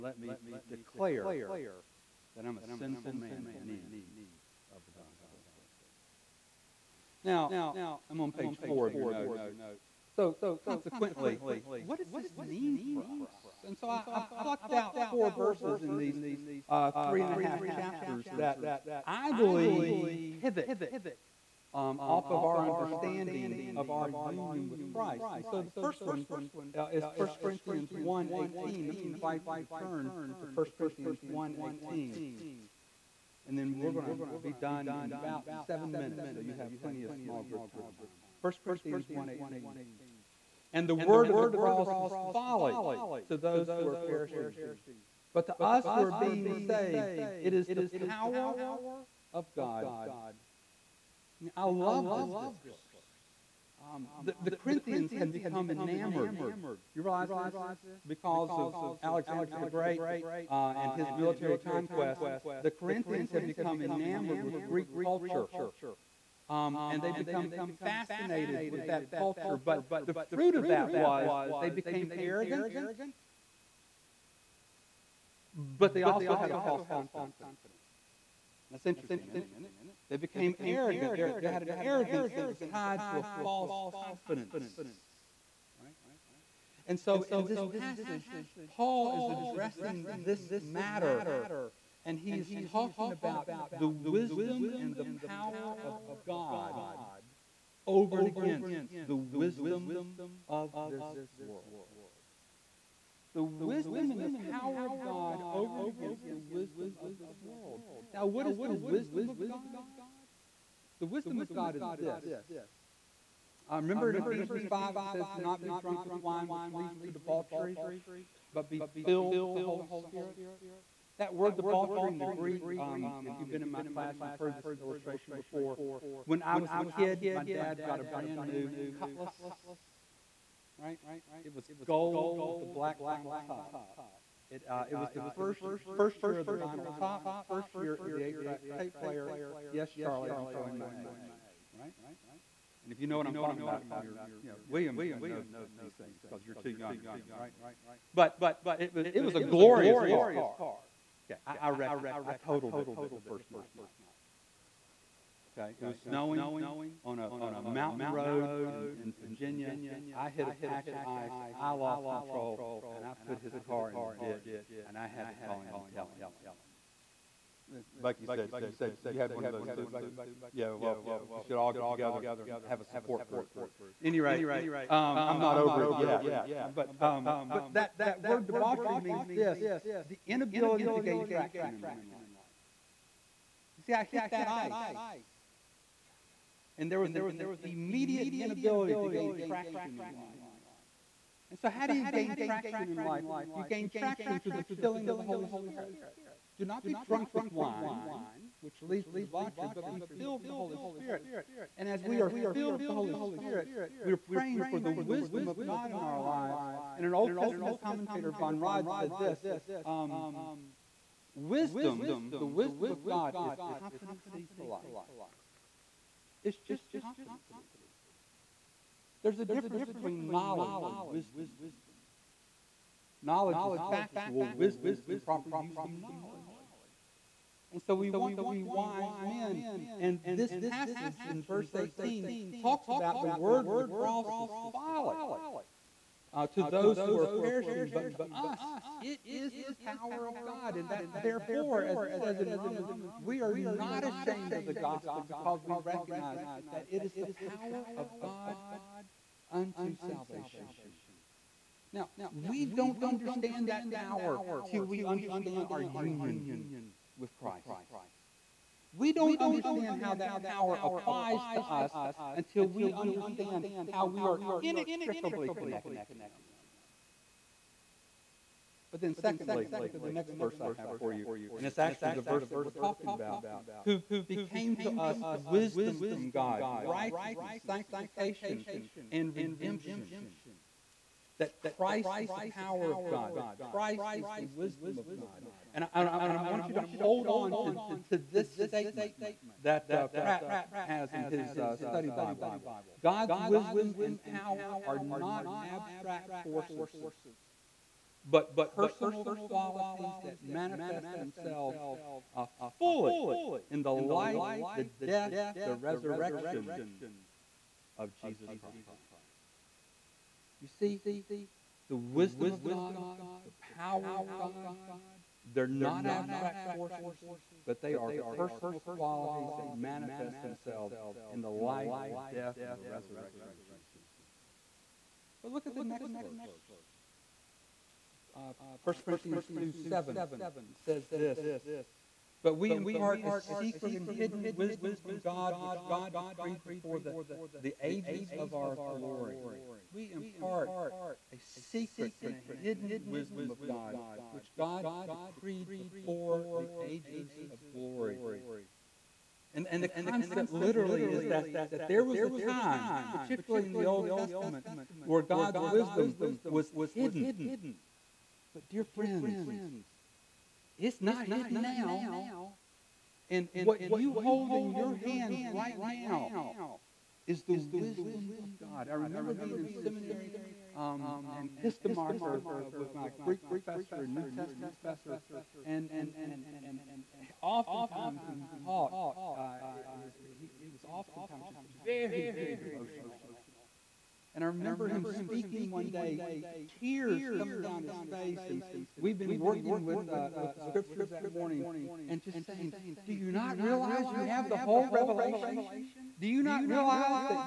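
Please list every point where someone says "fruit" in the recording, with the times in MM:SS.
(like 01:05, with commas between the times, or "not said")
01:10.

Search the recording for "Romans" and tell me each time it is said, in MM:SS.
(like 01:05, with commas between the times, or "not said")
04:02.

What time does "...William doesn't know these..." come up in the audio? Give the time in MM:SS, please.
02:24.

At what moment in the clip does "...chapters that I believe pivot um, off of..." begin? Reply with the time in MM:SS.
00:17.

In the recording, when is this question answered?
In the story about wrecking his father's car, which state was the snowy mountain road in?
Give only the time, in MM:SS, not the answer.
02:39.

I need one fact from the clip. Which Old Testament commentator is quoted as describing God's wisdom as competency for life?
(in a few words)
von Rad.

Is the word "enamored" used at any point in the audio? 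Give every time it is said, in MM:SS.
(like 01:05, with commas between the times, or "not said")
00:55, 01:03.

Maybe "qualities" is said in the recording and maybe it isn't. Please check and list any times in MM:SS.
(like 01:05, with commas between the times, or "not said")
04:59, 05:18.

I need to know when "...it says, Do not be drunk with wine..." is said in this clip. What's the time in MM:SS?
01:54.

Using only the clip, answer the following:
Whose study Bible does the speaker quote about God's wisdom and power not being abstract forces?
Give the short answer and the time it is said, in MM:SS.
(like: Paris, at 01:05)
Pratt, at 04:50.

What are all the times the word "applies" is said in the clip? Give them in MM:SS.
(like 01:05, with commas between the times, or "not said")
04:20.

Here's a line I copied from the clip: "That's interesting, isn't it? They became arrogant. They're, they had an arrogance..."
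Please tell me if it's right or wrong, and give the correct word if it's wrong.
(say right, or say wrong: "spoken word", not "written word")
right.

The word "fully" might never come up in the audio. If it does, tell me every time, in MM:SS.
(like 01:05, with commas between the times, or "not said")
05:02.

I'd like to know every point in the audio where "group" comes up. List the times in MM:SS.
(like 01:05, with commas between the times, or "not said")
00:37, 02:53.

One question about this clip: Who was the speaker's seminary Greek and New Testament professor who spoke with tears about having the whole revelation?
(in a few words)
Kistemaker.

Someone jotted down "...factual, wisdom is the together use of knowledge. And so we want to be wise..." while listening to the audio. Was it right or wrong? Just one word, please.
wrong.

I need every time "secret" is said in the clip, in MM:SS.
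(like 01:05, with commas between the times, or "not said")
05:33, 05:41.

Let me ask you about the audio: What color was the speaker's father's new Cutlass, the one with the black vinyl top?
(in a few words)
Gold.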